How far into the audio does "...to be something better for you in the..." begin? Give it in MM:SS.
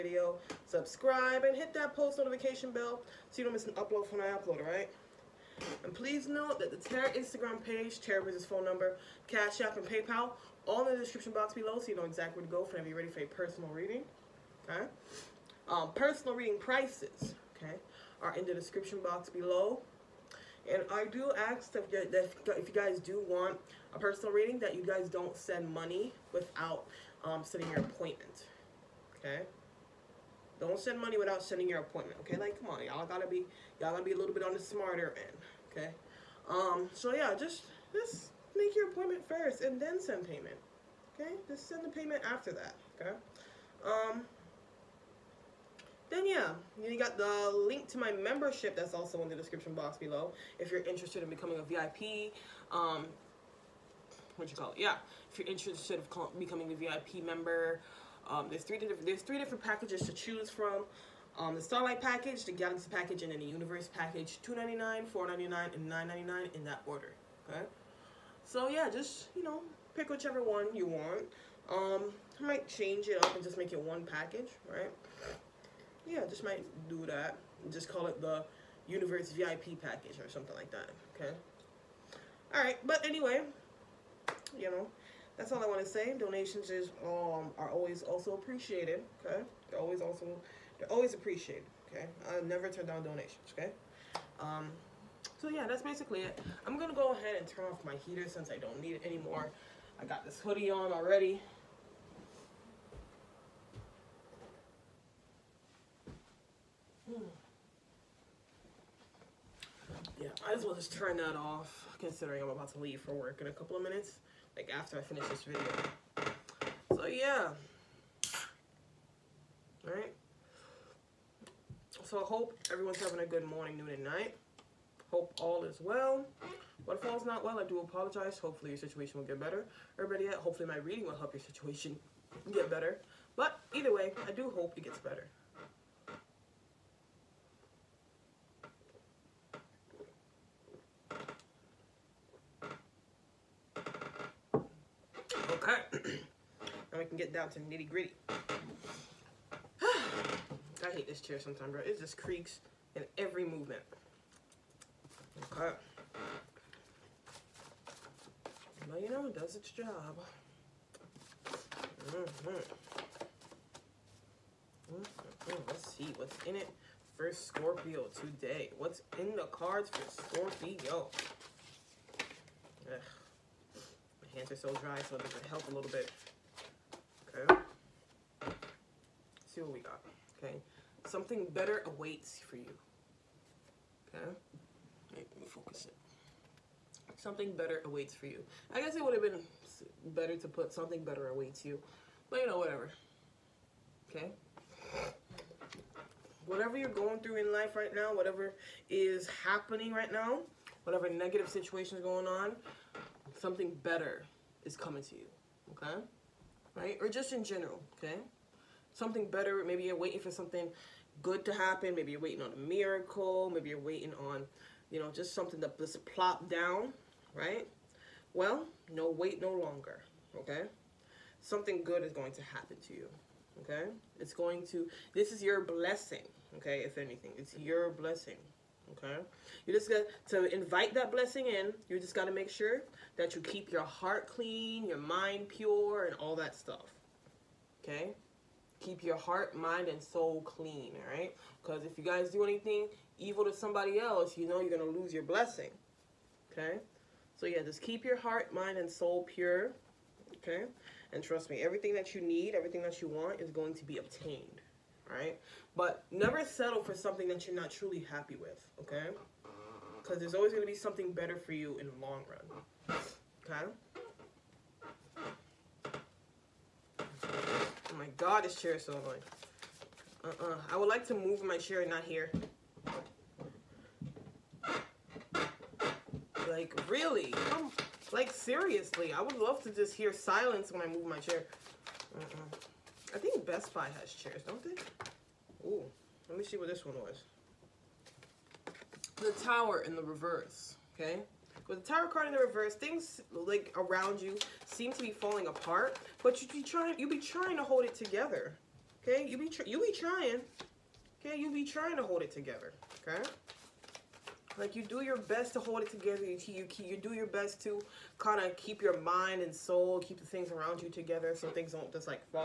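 04:20.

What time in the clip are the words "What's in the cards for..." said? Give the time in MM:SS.
02:48.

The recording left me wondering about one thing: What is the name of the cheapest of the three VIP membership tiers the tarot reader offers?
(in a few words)
Starlight package.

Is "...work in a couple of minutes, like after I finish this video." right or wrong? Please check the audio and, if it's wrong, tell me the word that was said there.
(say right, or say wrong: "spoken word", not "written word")
right.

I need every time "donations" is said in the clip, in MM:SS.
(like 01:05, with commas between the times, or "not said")
01:26, 01:33.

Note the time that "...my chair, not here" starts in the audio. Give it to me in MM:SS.
04:31.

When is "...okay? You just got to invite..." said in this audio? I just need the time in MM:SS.
03:48.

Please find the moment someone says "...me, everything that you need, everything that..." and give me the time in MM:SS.
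04:11.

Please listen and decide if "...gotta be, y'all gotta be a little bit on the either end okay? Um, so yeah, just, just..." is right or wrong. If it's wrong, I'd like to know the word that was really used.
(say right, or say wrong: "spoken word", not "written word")
wrong: "smarter", not "either".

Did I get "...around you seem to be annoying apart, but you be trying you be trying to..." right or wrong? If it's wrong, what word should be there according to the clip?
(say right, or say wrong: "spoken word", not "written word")
wrong: "falling", not "annoying".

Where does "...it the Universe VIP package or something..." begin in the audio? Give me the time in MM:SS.
01:18.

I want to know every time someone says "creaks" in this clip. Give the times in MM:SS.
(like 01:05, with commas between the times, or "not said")
02:32.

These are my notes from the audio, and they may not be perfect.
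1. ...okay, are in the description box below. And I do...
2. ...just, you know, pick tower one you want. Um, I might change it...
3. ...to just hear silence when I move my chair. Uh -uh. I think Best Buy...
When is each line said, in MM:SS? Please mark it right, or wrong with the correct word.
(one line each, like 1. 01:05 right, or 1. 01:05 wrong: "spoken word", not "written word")
1. 00:17 right
2. 01:08 wrong: "whichever", not "tower"
3. 04:39 right.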